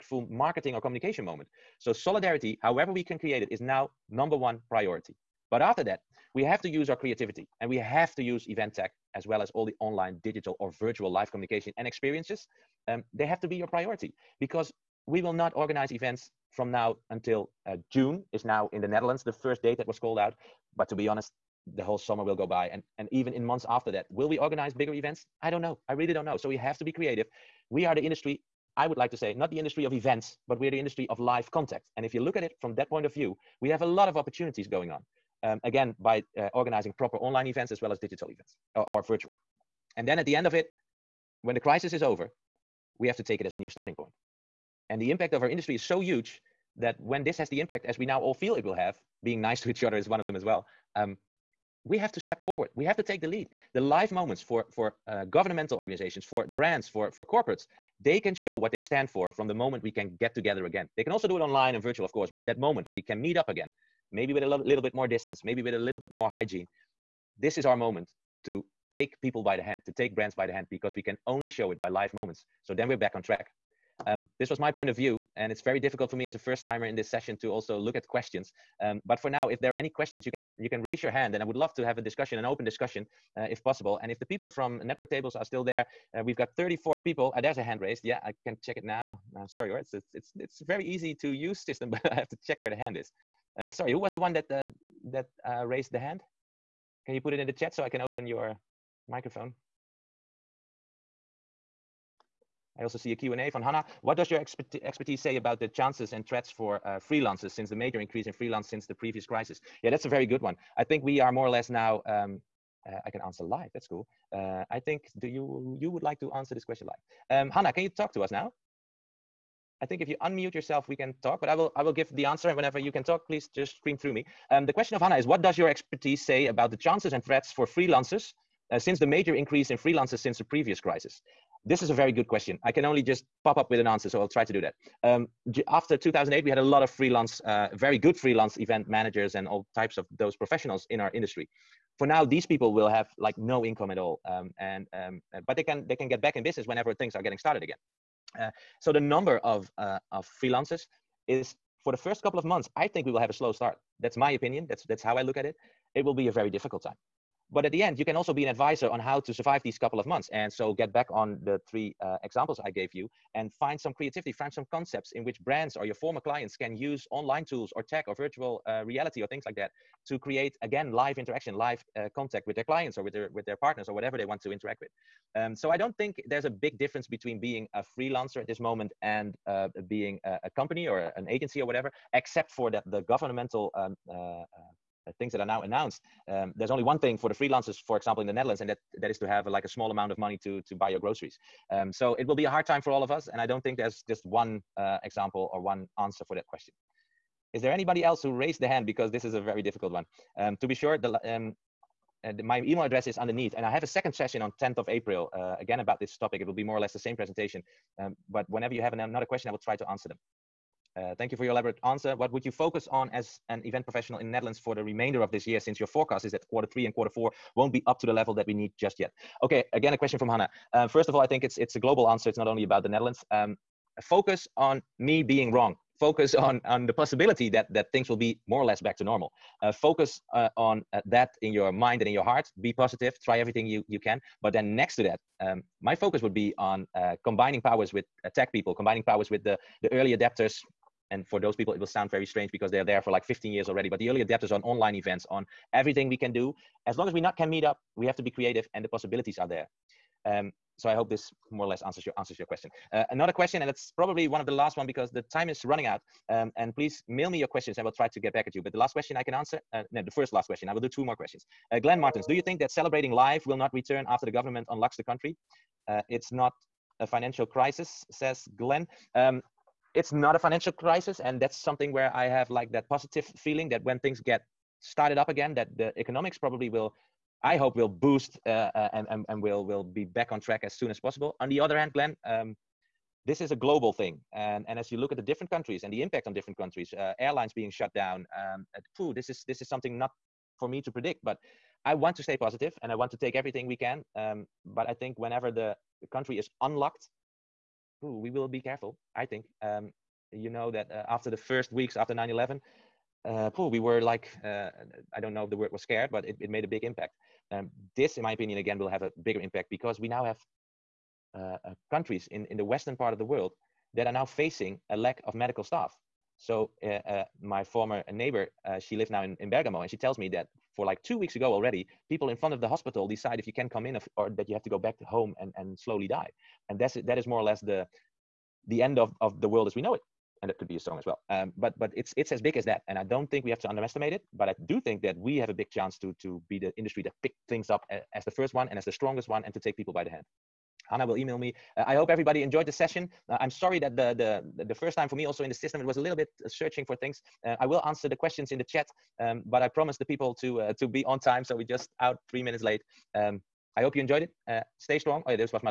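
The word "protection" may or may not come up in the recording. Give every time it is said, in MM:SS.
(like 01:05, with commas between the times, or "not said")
not said.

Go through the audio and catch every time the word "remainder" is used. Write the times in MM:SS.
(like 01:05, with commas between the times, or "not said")
03:34.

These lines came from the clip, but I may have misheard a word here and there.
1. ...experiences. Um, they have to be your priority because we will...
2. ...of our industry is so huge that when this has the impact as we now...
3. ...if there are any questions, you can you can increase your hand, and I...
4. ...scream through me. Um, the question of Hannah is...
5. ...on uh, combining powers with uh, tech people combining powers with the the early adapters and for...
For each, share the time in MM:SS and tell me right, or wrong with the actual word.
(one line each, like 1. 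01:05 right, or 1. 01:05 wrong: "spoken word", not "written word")
1. 00:11 right
2. 00:45 right
3. 01:19 wrong: "raise", not "increase"
4. 02:03 right
5. 03:56 right.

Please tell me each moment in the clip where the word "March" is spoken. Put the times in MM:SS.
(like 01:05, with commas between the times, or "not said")
not said.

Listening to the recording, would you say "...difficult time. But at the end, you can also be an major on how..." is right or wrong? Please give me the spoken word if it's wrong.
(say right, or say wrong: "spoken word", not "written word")
wrong: "advisor", not "major".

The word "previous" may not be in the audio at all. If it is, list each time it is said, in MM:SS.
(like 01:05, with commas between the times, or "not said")
01:48, 02:10.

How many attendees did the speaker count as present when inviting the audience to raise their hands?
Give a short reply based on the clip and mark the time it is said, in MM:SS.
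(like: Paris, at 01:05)
34, at 01:26.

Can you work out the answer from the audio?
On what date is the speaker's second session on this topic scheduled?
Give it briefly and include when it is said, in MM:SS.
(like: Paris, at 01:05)
10th of April, at 03:24.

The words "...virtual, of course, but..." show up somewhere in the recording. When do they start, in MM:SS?
01:01.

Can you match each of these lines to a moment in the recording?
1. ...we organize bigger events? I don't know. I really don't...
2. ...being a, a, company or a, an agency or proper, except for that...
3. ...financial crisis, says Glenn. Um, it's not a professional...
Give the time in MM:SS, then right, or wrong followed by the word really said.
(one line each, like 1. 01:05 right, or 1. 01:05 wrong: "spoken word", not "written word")
1. 00:24 right
2. 02:59 wrong: "whatever", not "proper"
3. 04:27 wrong: "financial", not "professional".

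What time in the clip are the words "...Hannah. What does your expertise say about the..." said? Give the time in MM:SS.
01:43.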